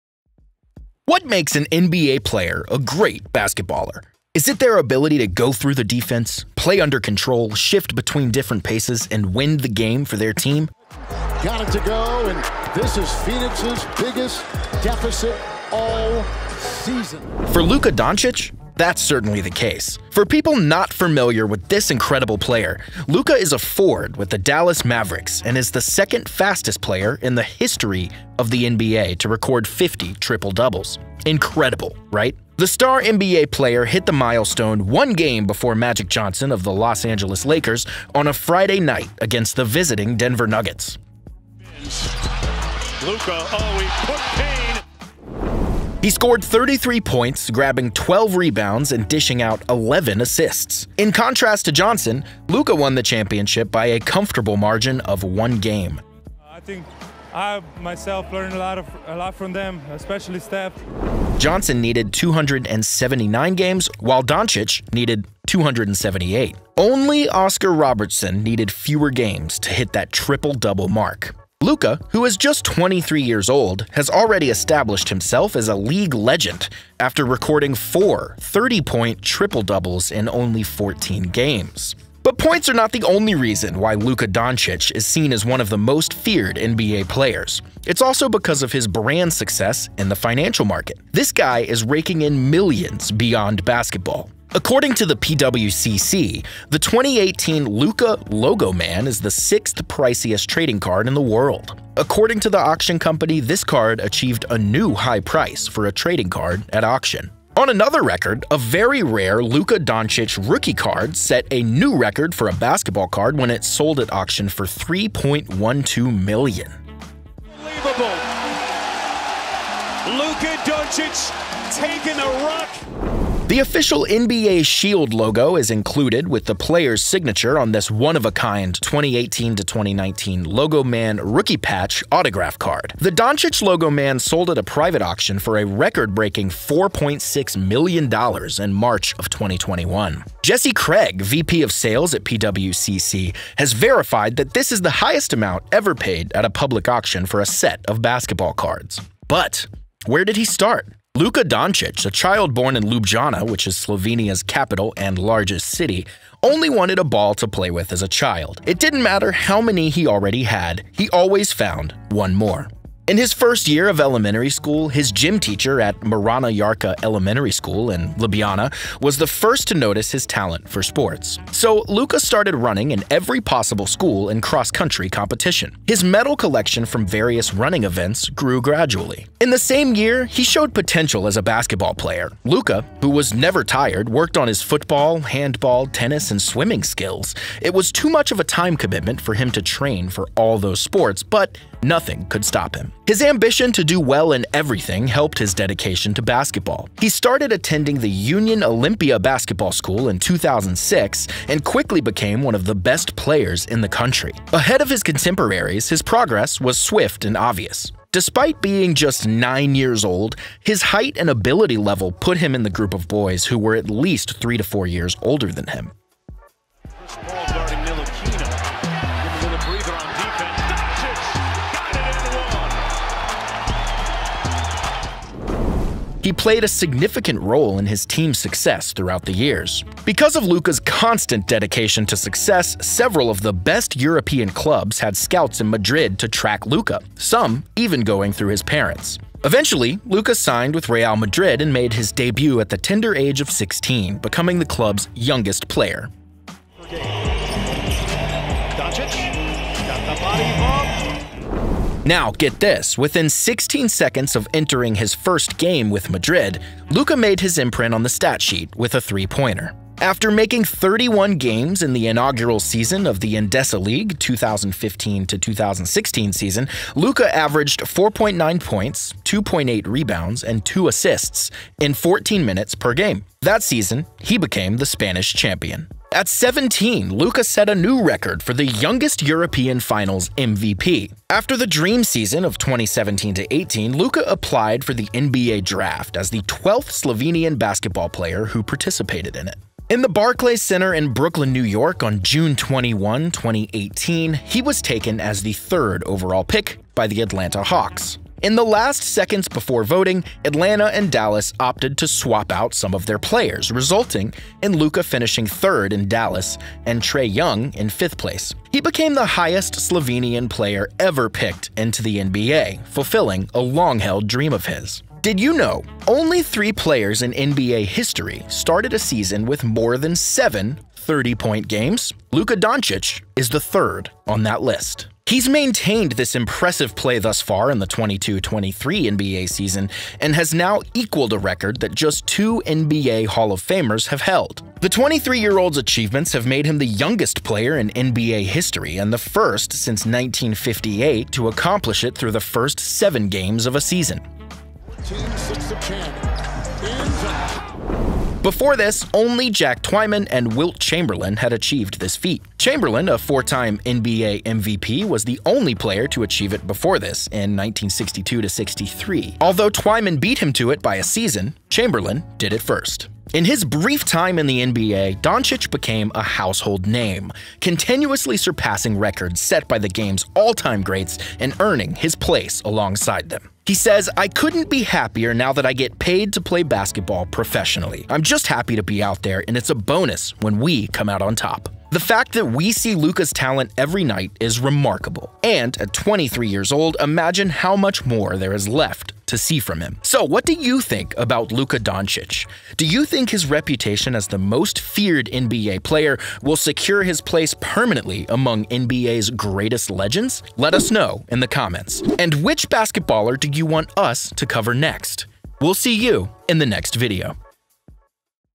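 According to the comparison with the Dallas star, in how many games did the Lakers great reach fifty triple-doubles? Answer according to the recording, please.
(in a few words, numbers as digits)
279.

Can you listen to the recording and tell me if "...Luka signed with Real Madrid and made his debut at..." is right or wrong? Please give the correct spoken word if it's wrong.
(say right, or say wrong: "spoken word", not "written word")
right.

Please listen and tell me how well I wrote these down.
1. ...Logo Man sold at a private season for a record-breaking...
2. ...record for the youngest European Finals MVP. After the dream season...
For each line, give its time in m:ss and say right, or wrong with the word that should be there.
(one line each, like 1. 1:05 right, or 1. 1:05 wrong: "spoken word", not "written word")
1. 2:13 wrong: "auction", not "season"
2. 4:38 right.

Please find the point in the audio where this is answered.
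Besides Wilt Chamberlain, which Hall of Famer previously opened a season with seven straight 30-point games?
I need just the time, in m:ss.
5:49.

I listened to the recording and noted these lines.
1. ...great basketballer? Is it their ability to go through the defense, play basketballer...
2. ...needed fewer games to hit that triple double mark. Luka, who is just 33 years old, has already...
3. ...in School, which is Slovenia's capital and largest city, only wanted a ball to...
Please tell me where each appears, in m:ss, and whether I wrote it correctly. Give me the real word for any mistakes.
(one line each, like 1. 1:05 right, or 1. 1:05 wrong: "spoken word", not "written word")
1. 0:02 wrong: "under", not "basketballer"
2. 1:08 wrong: "23", not "33"
3. 2:32 wrong: "Ljubljana", not "School".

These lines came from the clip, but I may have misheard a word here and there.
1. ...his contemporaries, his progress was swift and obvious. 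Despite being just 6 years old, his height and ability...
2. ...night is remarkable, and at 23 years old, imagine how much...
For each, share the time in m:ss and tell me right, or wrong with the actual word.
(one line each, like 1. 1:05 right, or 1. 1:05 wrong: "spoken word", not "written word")
1. 3:24 wrong: "9", not "6"
2. 6:24 right.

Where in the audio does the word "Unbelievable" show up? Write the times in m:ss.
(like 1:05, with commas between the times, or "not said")
1:57.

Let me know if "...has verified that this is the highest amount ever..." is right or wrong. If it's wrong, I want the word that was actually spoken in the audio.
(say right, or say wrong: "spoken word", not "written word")
right.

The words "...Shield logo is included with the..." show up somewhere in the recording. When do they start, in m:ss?
2:04.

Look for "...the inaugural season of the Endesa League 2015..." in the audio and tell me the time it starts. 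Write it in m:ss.
4:21.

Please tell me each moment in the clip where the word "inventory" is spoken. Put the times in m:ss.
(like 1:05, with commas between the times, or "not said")
not said.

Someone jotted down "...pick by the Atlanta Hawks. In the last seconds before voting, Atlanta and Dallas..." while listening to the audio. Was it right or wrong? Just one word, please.
right.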